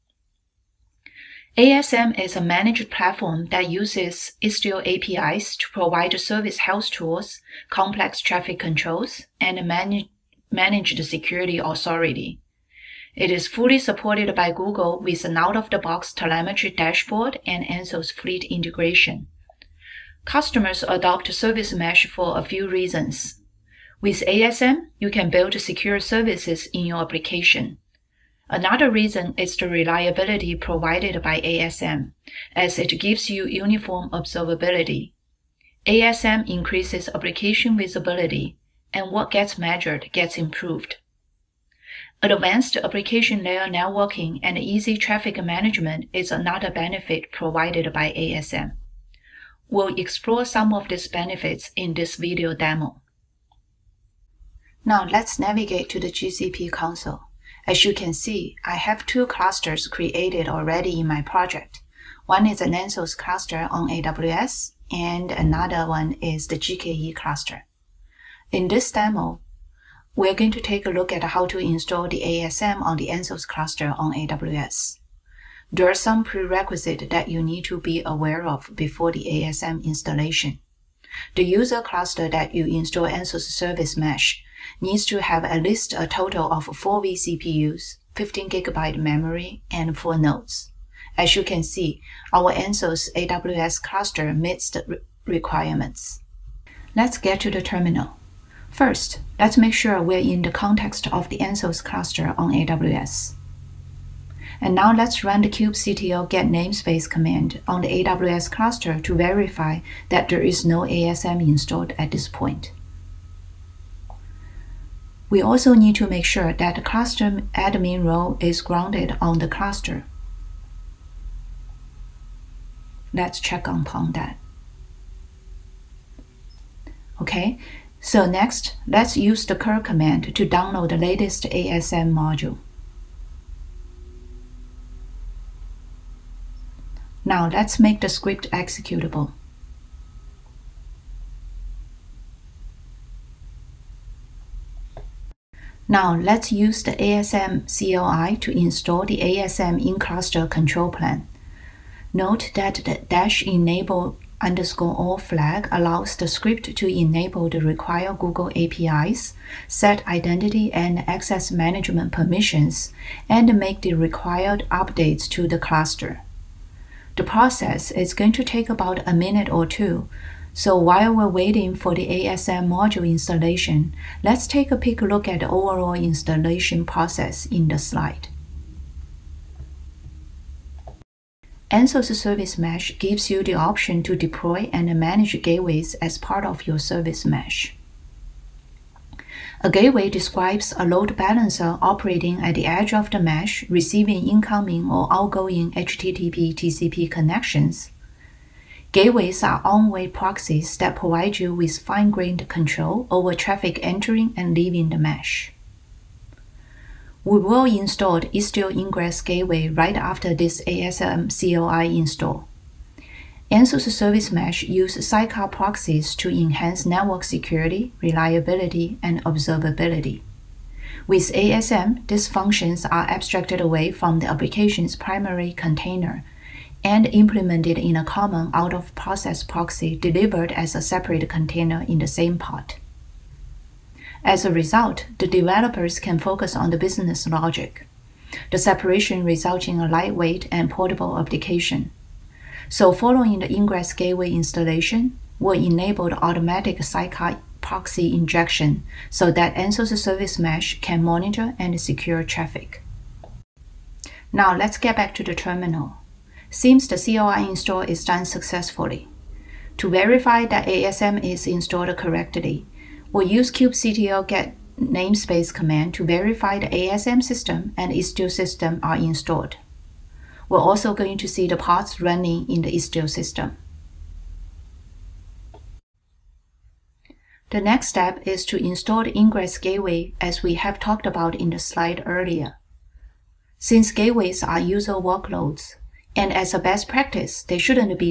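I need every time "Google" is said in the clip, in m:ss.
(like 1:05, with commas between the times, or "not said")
0:14, 2:38.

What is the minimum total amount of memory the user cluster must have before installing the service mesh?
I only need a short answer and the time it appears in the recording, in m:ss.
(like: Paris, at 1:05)
15 GB, at 1:28.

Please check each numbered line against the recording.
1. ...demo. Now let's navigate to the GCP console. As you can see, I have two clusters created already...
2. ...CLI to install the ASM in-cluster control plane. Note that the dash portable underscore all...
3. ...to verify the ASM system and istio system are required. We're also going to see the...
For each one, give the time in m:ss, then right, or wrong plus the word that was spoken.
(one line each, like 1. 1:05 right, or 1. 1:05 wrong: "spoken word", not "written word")
1. 0:52 right
2. 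2:27 wrong: "enable", not "portable"
3. 4:25 wrong: "installed", not "required".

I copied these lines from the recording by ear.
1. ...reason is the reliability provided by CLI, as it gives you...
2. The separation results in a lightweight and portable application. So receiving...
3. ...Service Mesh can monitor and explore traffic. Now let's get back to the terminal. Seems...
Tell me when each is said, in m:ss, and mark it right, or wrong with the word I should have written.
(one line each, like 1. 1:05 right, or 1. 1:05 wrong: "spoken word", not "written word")
1. 0:28 wrong: "ASM", not "CLI"
2. 3:58 wrong: "following", not "receiving"
3. 4:09 wrong: "secure", not "explore".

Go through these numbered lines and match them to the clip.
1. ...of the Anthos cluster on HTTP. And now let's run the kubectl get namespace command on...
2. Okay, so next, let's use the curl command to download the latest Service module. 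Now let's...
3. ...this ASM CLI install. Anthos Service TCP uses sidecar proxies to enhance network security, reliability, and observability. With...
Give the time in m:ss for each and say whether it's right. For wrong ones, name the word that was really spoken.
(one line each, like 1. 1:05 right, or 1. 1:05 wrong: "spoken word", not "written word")
1. 1:41 wrong: "AWS", not "HTTP"
2. 2:07 wrong: "ASM", not "Service"
3. 3:30 wrong: "Mesh", not "TCP".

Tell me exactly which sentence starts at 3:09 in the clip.
A gateway describes a load balancer operating at the edge of the mesh, receiving incoming or outgoing HTTP TCP connections.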